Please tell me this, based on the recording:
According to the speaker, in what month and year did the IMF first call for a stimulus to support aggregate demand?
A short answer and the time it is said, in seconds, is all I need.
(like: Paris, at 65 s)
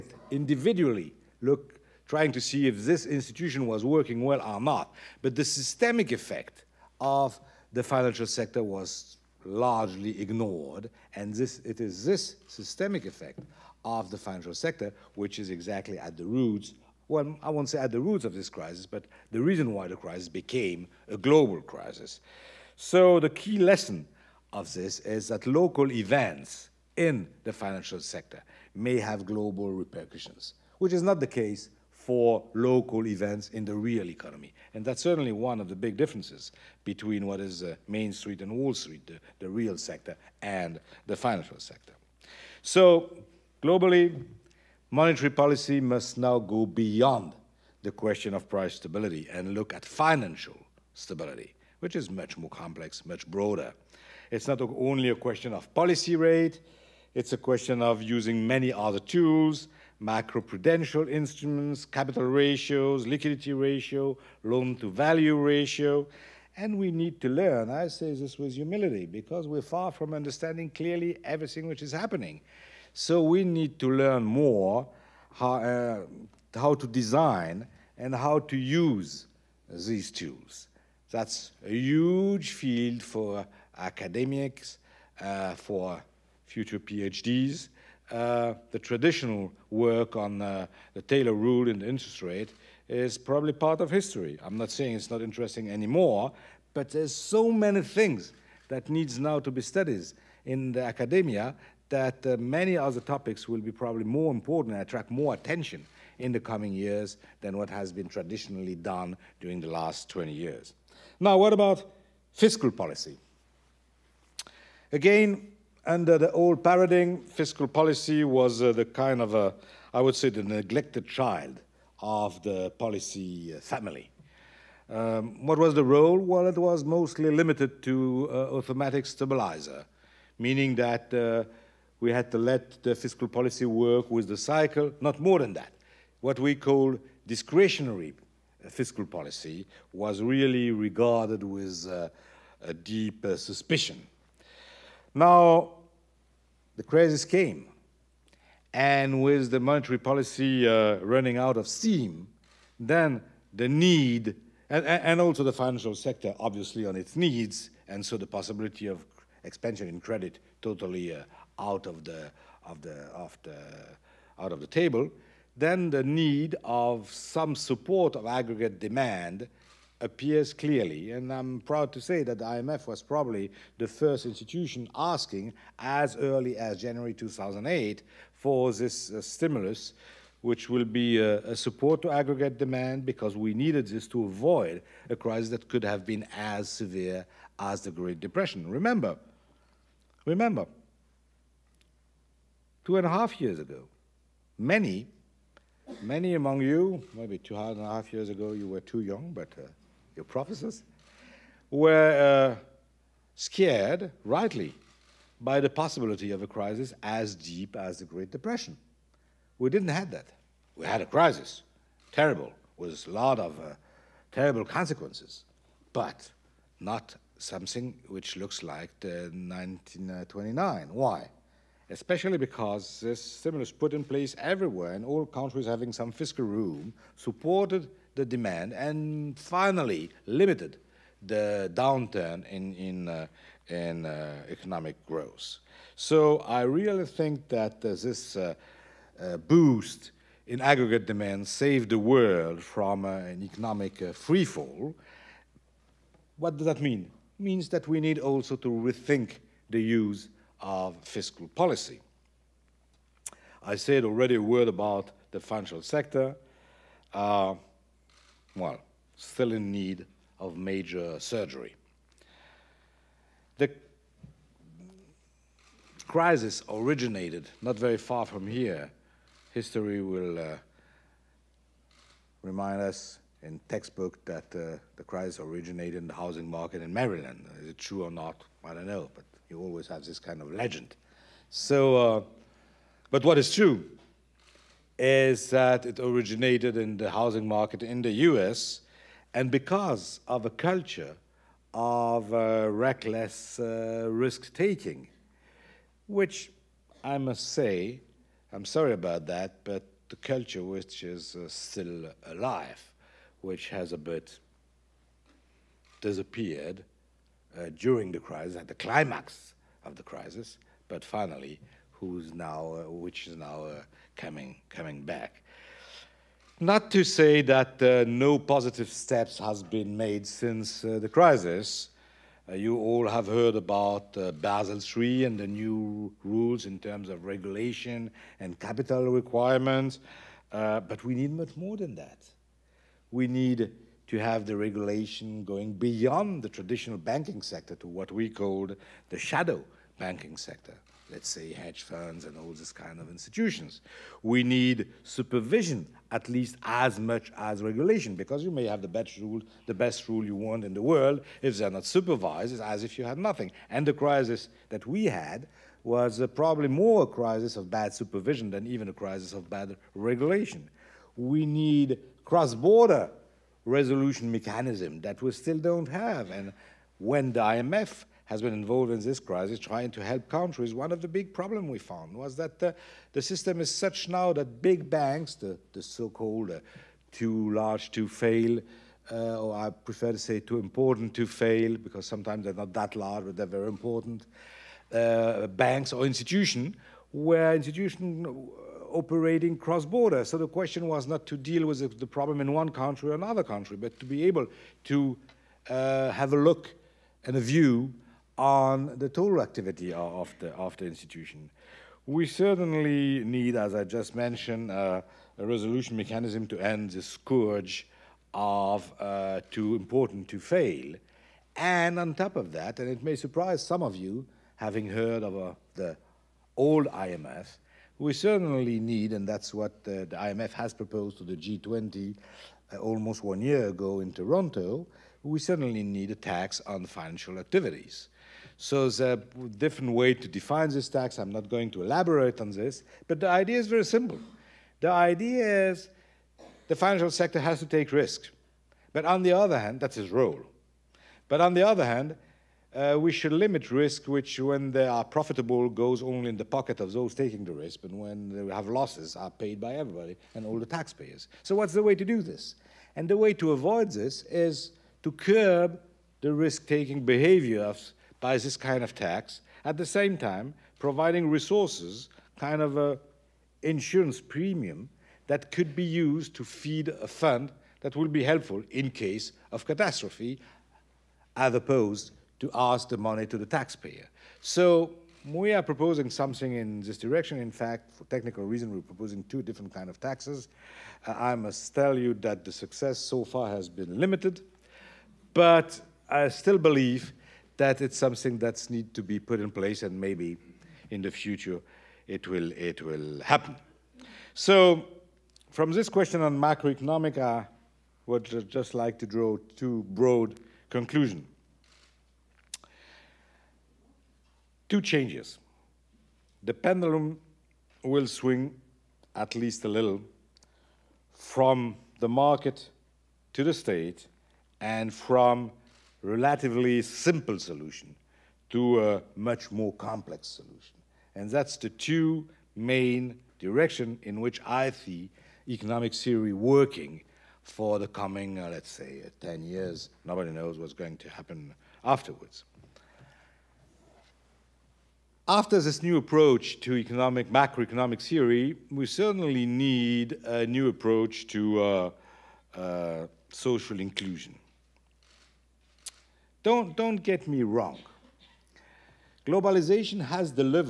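January 2008, at 176 s.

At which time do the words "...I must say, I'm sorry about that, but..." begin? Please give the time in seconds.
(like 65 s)
297 s.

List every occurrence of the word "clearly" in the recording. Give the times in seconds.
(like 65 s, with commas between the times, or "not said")
70 s, 170 s.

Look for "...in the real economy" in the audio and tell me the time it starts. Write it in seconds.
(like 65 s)
33 s.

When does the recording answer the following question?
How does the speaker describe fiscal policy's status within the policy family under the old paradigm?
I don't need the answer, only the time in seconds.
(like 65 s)
120 s.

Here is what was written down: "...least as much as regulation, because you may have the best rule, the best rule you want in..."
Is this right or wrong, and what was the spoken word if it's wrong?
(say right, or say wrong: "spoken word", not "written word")
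right.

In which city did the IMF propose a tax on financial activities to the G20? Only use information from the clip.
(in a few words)
Toronto.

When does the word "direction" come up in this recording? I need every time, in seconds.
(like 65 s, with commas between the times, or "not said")
476 s, 523 s.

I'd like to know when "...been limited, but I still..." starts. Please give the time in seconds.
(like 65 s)
483 s.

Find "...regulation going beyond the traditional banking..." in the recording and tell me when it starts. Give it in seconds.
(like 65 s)
334 s.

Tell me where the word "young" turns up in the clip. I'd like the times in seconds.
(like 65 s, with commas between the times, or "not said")
199 s.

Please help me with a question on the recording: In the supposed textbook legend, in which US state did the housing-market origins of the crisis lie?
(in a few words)
Maryland.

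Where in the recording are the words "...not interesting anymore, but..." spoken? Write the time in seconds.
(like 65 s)
95 s.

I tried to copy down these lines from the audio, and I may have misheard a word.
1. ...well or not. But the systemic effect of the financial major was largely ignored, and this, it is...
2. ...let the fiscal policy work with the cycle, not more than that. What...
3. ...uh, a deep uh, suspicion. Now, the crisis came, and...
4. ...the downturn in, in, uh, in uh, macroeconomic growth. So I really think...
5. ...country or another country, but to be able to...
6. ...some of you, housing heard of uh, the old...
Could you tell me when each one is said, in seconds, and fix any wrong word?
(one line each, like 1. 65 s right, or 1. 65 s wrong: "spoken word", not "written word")
1. 4 s wrong: "sector", not "major"
2. 132 s right
3. 141 s right
4. 231 s wrong: "economic", not "macroeconomic"
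5. 392 s right
6. 413 s wrong: "having", not "housing".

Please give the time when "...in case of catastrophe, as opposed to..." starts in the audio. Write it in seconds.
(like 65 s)
468 s.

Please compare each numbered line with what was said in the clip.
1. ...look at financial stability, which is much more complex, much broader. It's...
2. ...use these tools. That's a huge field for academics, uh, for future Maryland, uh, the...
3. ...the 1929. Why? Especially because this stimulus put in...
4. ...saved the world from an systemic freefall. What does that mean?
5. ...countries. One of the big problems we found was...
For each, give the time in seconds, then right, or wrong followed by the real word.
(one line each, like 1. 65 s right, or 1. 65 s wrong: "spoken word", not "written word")
1. 49 s right
2. 78 s wrong: "PhDs", not "Maryland"
3. 218 s right
4. 241 s wrong: "economic", not "systemic"
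5. 370 s right.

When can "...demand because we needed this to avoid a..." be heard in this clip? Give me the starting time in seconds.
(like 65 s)
182 s.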